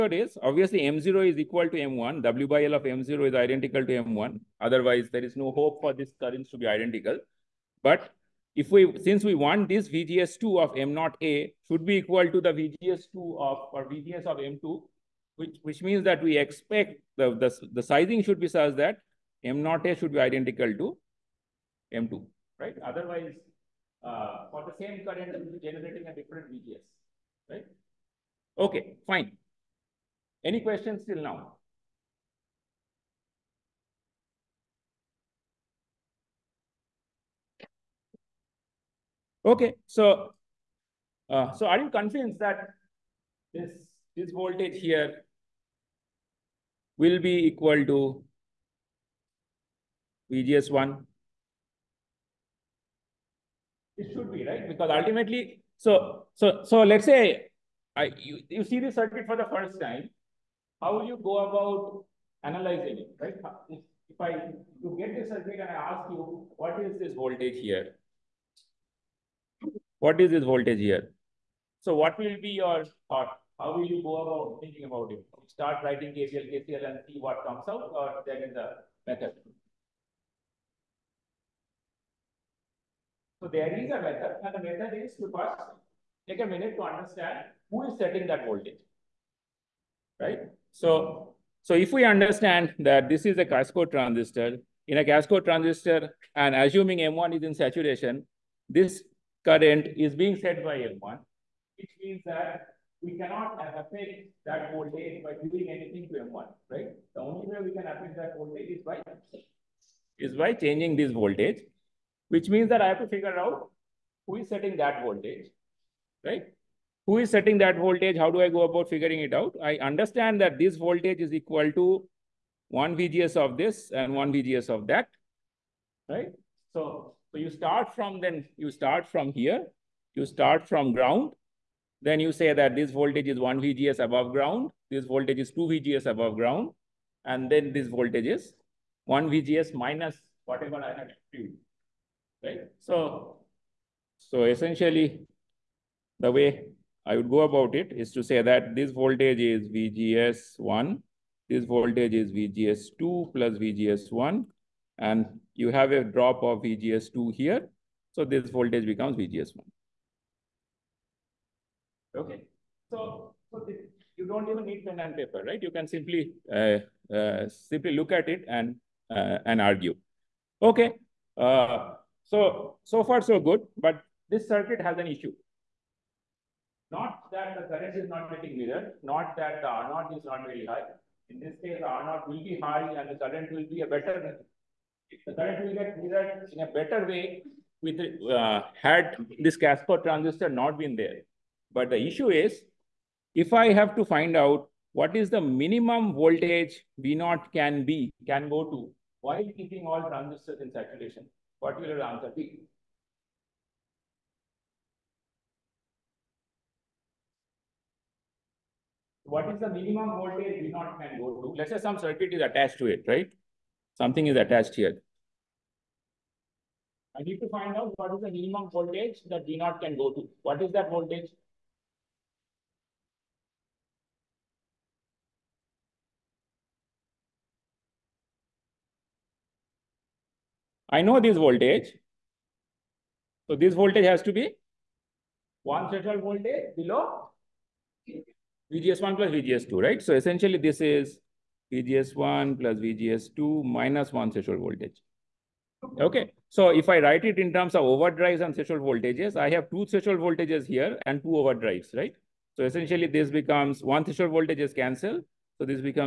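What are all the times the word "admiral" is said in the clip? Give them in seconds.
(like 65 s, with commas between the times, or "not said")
not said.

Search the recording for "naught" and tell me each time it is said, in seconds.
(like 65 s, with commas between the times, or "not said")
210 s, 219 s.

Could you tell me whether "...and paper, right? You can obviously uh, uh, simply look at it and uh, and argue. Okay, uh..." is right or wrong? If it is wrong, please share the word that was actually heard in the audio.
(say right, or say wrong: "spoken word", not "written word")
wrong: "simply", not "obviously".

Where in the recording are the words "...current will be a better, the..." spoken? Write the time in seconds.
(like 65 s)
183 s.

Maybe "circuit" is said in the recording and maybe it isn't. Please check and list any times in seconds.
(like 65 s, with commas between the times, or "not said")
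58 s, 65 s, 174 s, 211 s.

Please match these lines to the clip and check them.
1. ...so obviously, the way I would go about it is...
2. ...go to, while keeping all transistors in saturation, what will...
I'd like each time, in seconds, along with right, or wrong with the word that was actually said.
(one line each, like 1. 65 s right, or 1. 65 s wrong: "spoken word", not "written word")
1. 144 s wrong: "essentially", not "obviously"
2. 198 s right.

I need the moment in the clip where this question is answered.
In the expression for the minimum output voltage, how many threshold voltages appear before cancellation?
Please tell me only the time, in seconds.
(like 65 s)
249 s.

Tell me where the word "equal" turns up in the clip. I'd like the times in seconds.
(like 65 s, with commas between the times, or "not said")
1 s, 11 s, 47 s, 121 s.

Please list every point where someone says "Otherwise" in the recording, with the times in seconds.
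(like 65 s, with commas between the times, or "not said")
4 s, 22 s.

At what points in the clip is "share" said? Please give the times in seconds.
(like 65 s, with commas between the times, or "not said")
not said.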